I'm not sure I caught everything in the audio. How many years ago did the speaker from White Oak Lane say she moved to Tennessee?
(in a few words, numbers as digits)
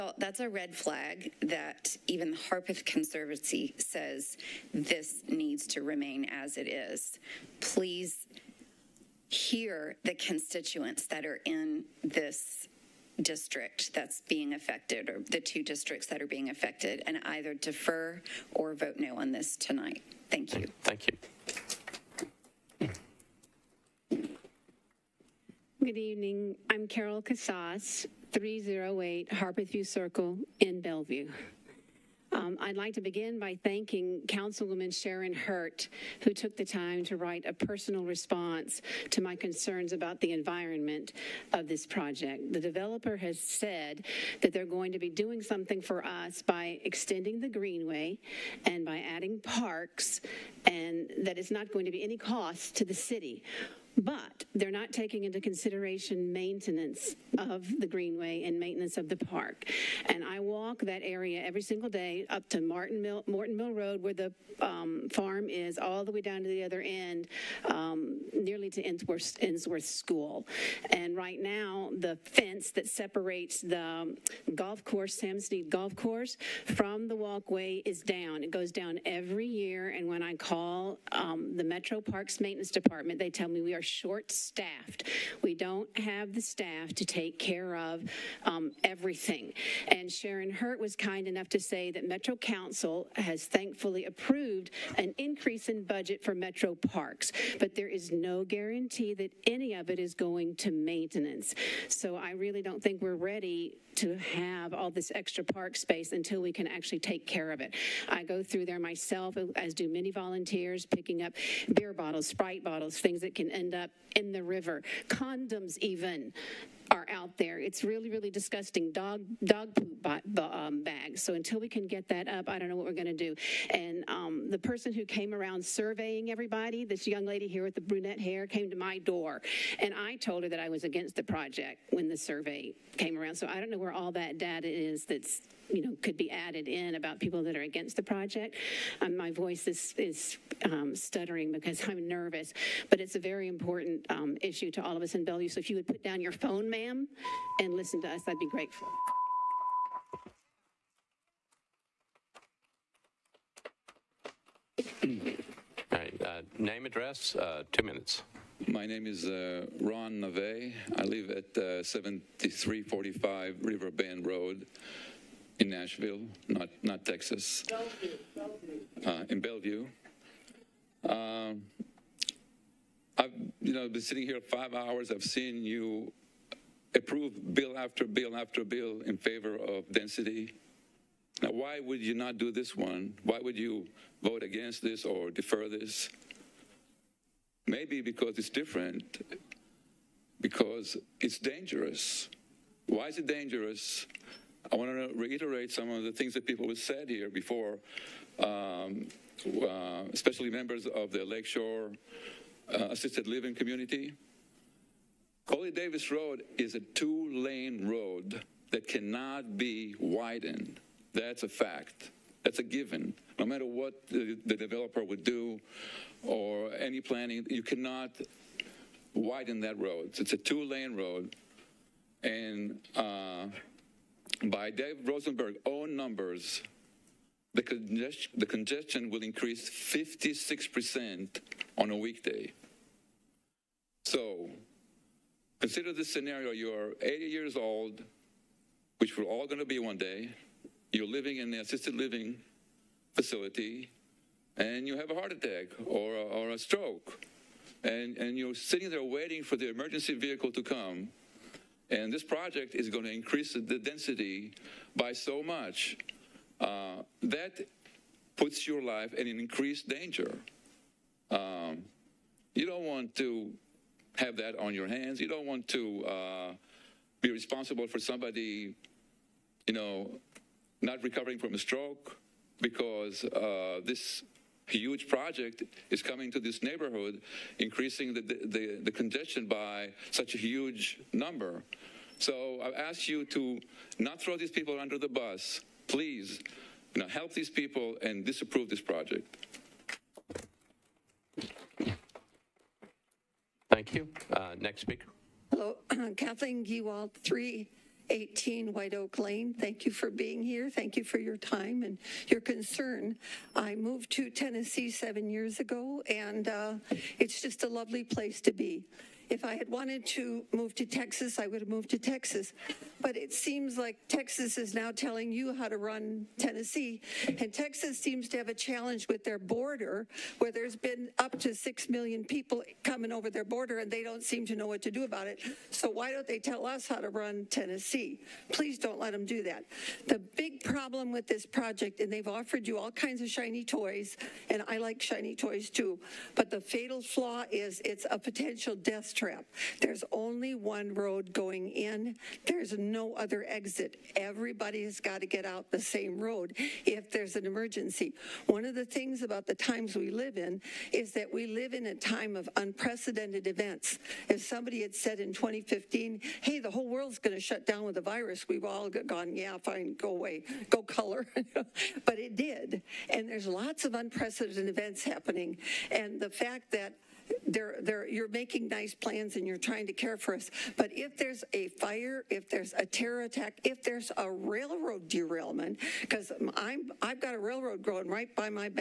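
7.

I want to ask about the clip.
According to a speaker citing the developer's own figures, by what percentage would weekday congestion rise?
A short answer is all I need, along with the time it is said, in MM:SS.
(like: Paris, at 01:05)
56%, at 03:49.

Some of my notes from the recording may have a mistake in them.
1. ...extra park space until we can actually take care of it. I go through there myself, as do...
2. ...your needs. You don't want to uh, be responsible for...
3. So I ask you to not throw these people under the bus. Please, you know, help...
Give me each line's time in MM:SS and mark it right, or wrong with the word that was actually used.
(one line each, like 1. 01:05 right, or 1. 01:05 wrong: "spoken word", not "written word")
1. 01:45 right
2. 04:24 wrong: "hands", not "needs"
3. 04:42 right.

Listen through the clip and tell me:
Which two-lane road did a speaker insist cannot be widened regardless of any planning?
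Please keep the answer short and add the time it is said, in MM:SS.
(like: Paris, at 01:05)
Coley Davis Road, at 03:25.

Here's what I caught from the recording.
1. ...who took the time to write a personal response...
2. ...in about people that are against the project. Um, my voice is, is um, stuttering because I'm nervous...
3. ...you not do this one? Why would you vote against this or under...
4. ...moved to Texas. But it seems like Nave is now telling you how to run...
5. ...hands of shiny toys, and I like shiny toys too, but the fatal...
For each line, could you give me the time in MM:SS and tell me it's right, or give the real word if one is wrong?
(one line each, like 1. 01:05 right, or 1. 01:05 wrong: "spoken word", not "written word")
1. 00:36 right
2. 02:16 right
3. 03:01 wrong: "defer", not "under"
4. 05:11 wrong: "Texas", not "Nave"
5. 05:32 wrong: "kinds", not "hands".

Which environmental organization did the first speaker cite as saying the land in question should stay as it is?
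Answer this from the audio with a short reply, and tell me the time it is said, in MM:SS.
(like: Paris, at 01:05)
Harpeth Conservancy, at 00:02.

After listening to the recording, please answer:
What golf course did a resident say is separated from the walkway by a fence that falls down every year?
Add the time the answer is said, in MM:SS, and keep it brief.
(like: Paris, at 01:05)
Sam Need Golf Course, at 01:15.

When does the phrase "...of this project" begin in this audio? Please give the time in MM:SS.
00:41.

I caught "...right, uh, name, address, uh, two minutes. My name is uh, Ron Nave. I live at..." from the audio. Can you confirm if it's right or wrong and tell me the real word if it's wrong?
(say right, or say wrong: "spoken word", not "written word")
right.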